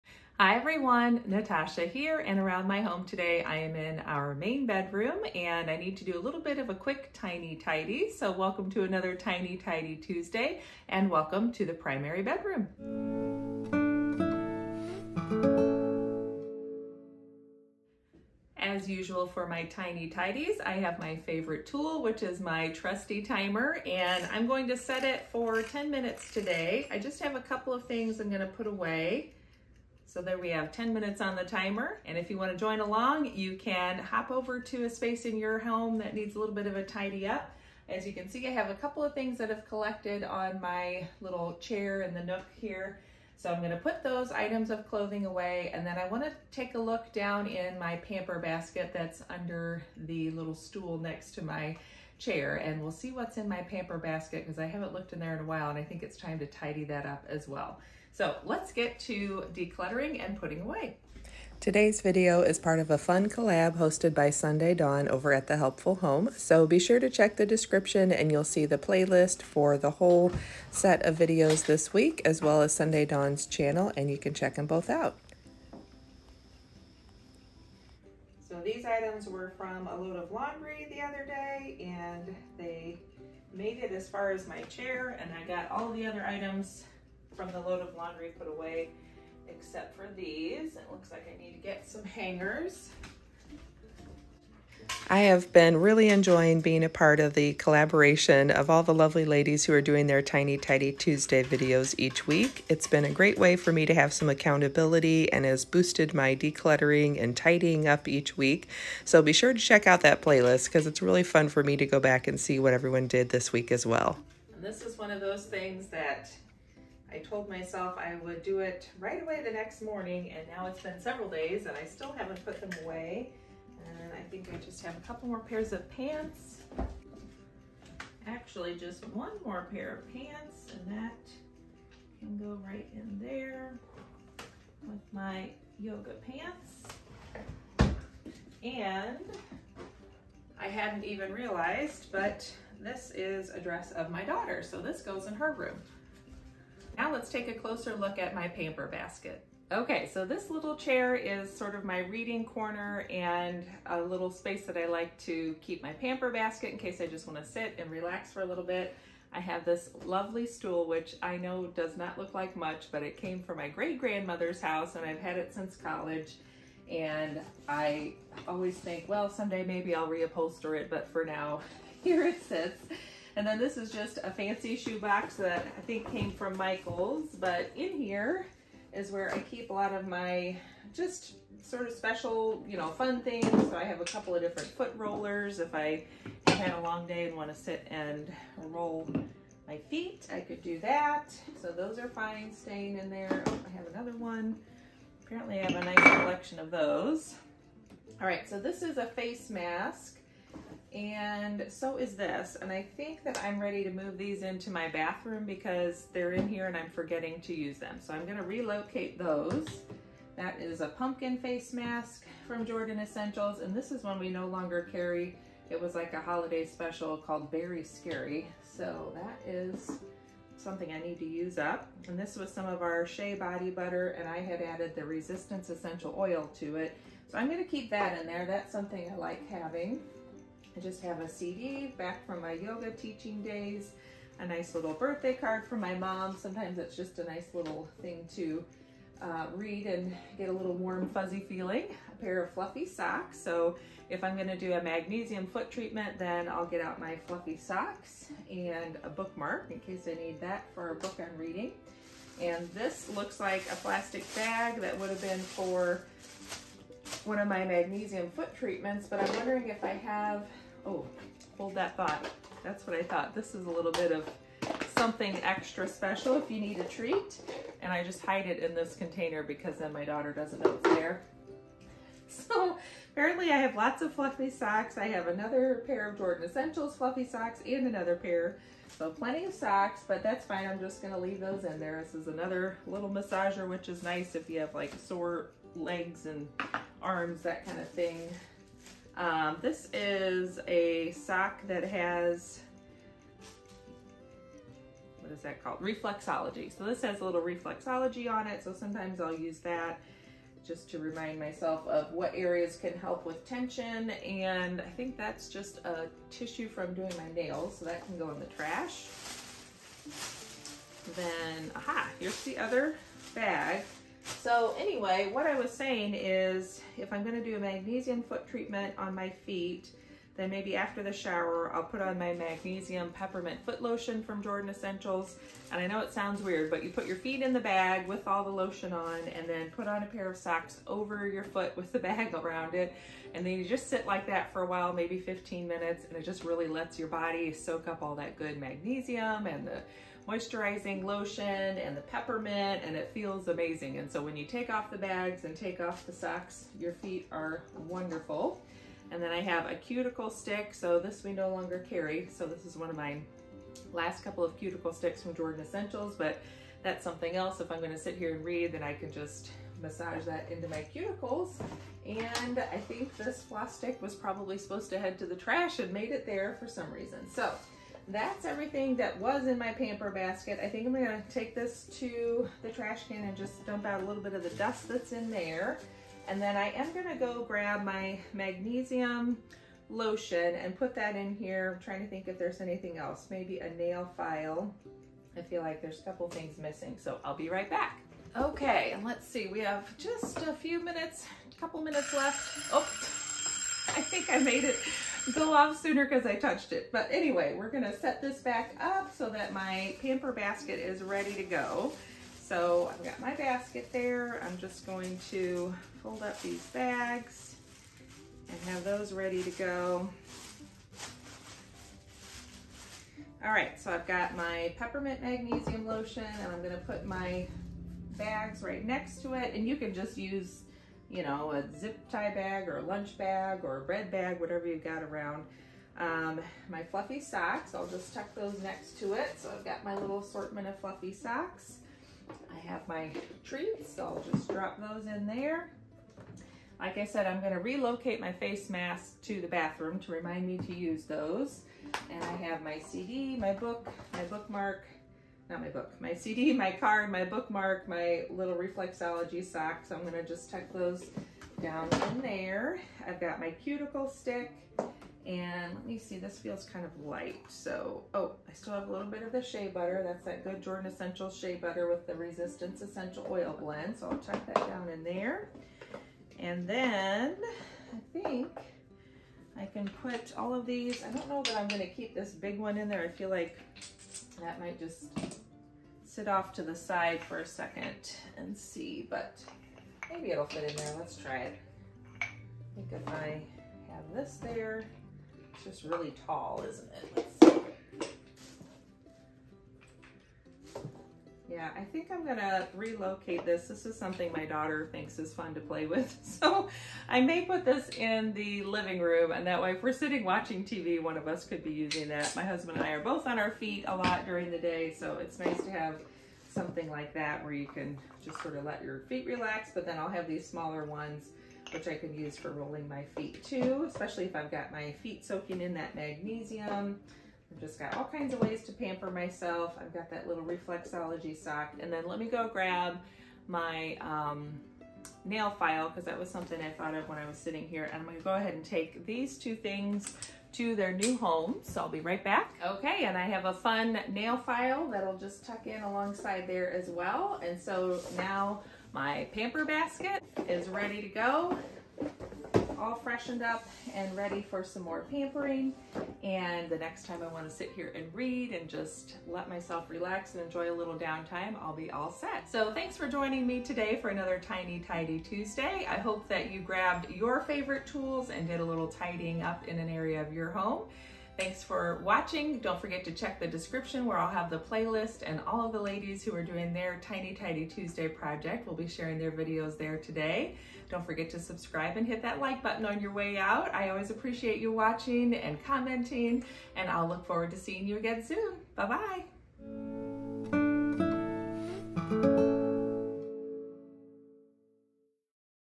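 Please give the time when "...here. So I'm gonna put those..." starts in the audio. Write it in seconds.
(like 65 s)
42 s.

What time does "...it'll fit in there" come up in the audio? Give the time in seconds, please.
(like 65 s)
480 s.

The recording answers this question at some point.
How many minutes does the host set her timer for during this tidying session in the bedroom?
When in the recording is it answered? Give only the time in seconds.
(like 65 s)
30 s.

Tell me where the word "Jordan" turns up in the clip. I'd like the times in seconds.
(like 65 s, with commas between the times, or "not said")
212 s, 276 s, 324 s, 355 s, 460 s.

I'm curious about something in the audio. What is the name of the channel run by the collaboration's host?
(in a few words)
The Helpful Home.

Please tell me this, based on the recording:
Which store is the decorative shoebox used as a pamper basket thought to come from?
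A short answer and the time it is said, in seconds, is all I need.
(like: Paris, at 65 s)
Michael's, at 176 s.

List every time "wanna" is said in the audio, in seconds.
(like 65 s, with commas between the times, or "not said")
32 s, 46 s, 157 s.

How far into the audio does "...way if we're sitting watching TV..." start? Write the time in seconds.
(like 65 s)
499 s.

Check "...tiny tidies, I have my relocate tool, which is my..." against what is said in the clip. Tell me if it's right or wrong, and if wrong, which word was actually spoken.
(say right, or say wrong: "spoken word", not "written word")
wrong: "favorite", not "relocate".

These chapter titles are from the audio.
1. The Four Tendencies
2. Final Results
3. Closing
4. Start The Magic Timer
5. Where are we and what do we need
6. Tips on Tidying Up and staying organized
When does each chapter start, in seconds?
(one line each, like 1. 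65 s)
1. 425 s
2. 248 s
3. 460 s
4. 60 s
5. 29 s
6. 332 s.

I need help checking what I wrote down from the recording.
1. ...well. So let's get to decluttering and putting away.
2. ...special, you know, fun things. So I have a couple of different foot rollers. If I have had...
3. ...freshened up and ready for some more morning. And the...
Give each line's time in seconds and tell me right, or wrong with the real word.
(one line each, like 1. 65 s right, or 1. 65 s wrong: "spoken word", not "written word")
1. 57 s right
2. 181 s right
3. 542 s wrong: "pampering", not "morning".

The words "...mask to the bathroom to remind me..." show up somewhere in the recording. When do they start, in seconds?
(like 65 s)
438 s.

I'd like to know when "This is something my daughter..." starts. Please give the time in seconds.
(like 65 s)
493 s.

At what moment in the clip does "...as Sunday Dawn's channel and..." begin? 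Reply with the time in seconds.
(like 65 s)
72 s.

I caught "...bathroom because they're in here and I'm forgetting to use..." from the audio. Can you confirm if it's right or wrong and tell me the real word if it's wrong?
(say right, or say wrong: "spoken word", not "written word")
right.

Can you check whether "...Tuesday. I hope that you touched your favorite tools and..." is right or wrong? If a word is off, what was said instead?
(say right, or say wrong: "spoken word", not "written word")
wrong: "grabbed", not "touched".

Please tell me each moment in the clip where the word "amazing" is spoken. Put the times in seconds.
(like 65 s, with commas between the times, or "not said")
343 s.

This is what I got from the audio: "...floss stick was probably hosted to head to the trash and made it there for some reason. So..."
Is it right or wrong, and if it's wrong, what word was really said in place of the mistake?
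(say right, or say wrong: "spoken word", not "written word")
wrong: "supposed", not "hosted".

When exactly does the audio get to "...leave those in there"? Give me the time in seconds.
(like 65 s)
281 s.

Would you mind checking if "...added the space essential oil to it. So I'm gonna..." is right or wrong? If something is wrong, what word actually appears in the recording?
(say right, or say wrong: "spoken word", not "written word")
wrong: "resistance", not "space".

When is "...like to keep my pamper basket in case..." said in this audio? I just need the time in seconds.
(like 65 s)
154 s.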